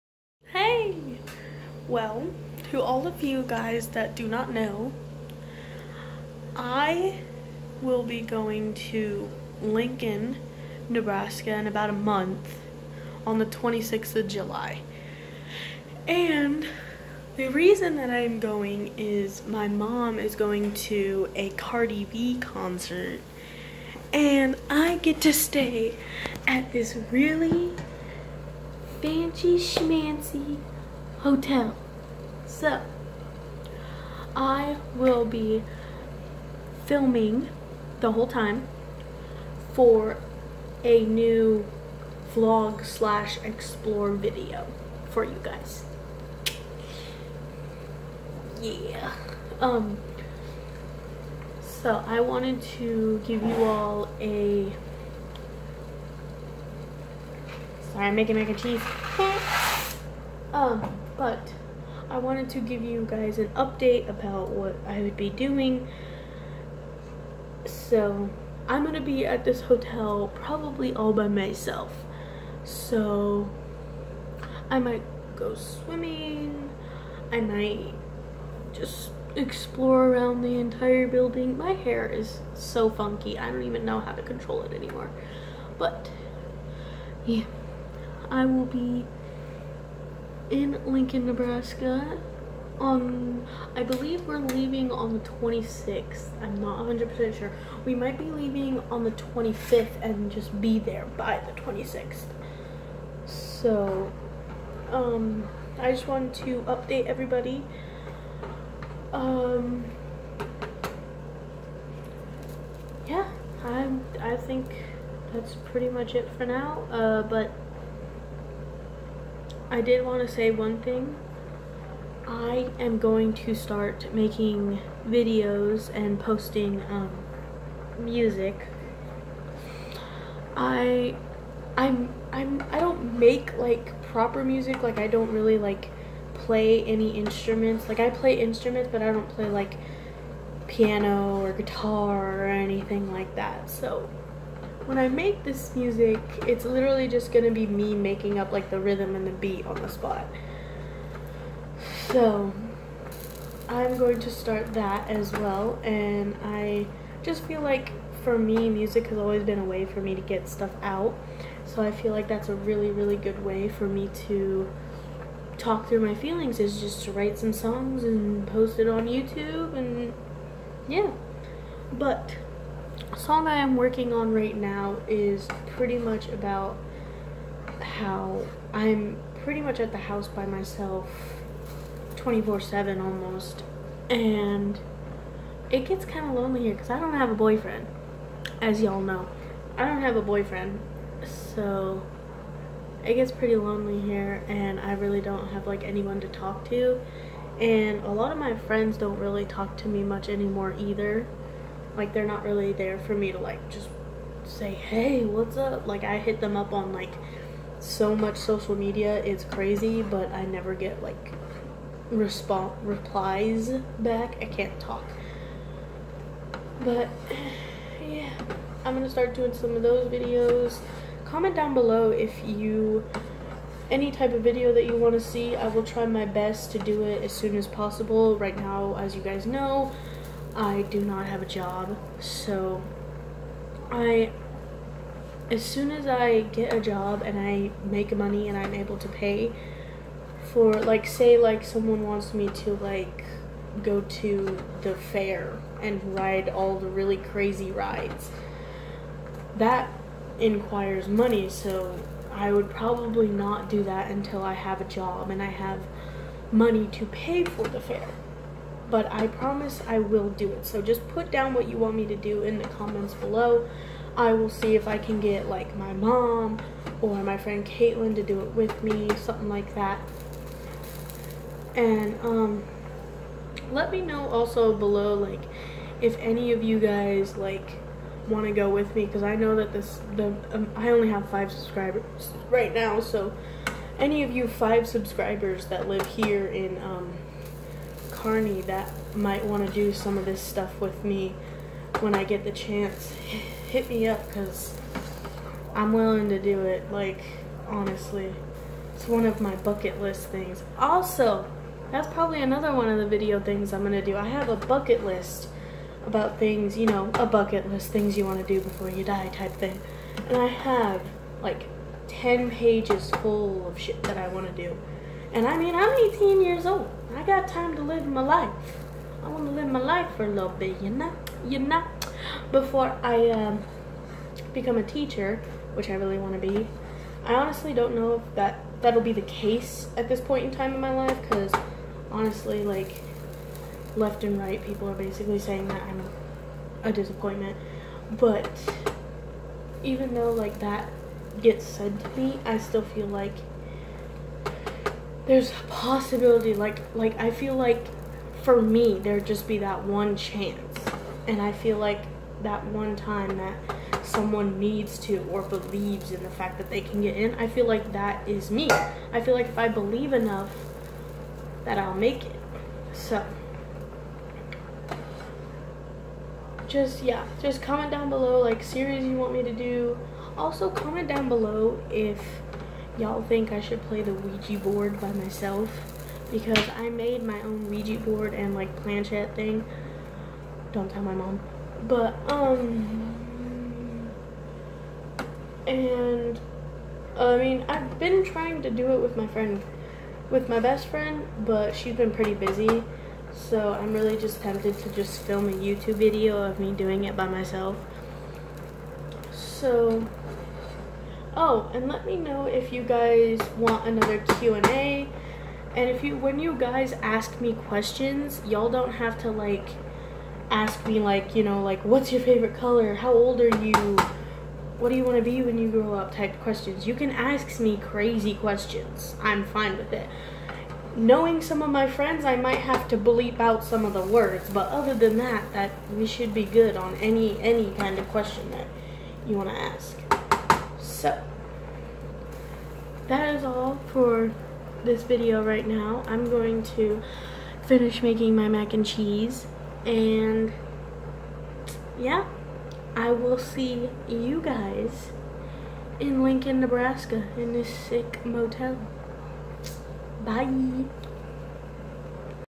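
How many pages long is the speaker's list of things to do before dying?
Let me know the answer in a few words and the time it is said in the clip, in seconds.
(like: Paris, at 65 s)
10, at 312 s.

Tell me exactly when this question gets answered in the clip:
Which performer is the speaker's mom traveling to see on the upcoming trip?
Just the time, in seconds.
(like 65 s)
21 s.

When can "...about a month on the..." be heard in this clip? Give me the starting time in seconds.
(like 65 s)
11 s.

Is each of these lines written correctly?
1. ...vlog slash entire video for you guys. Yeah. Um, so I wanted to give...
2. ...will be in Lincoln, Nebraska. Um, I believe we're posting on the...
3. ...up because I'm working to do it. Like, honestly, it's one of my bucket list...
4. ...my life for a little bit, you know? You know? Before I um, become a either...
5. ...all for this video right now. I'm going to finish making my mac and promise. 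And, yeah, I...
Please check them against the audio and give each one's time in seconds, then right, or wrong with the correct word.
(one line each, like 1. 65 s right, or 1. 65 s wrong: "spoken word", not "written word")
1. 42 s wrong: "explore", not "entire"
2. 88 s wrong: "leaving", not "posting"
3. 294 s wrong: "willing", not "working"
4. 319 s wrong: "teacher", not "either"
5. 433 s wrong: "cheese", not "promise".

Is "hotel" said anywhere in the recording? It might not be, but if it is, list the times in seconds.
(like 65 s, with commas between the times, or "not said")
31 s, 69 s.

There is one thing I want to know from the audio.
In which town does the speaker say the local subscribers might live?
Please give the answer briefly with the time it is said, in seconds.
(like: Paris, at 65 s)
Kearney, at 288 s.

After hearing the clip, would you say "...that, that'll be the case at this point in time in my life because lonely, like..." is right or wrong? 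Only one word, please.
wrong.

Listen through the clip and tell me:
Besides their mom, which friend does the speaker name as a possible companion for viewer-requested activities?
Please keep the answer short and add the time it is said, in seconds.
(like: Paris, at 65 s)
Caitlin, at 267 s.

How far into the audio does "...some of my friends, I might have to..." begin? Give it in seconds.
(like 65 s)
421 s.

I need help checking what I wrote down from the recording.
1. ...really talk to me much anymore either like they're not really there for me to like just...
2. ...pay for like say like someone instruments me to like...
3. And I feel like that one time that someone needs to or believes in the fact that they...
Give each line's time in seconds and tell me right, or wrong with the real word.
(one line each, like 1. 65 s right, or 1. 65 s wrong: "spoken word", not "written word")
1. 199 s right
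2. 239 s wrong: "wants", not "instruments"
3. 351 s right.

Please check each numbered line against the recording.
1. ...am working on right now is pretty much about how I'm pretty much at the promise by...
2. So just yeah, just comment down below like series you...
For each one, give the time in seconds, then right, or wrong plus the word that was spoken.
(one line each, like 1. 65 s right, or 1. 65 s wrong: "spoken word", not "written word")
1. 173 s wrong: "house", not "promise"
2. 362 s right.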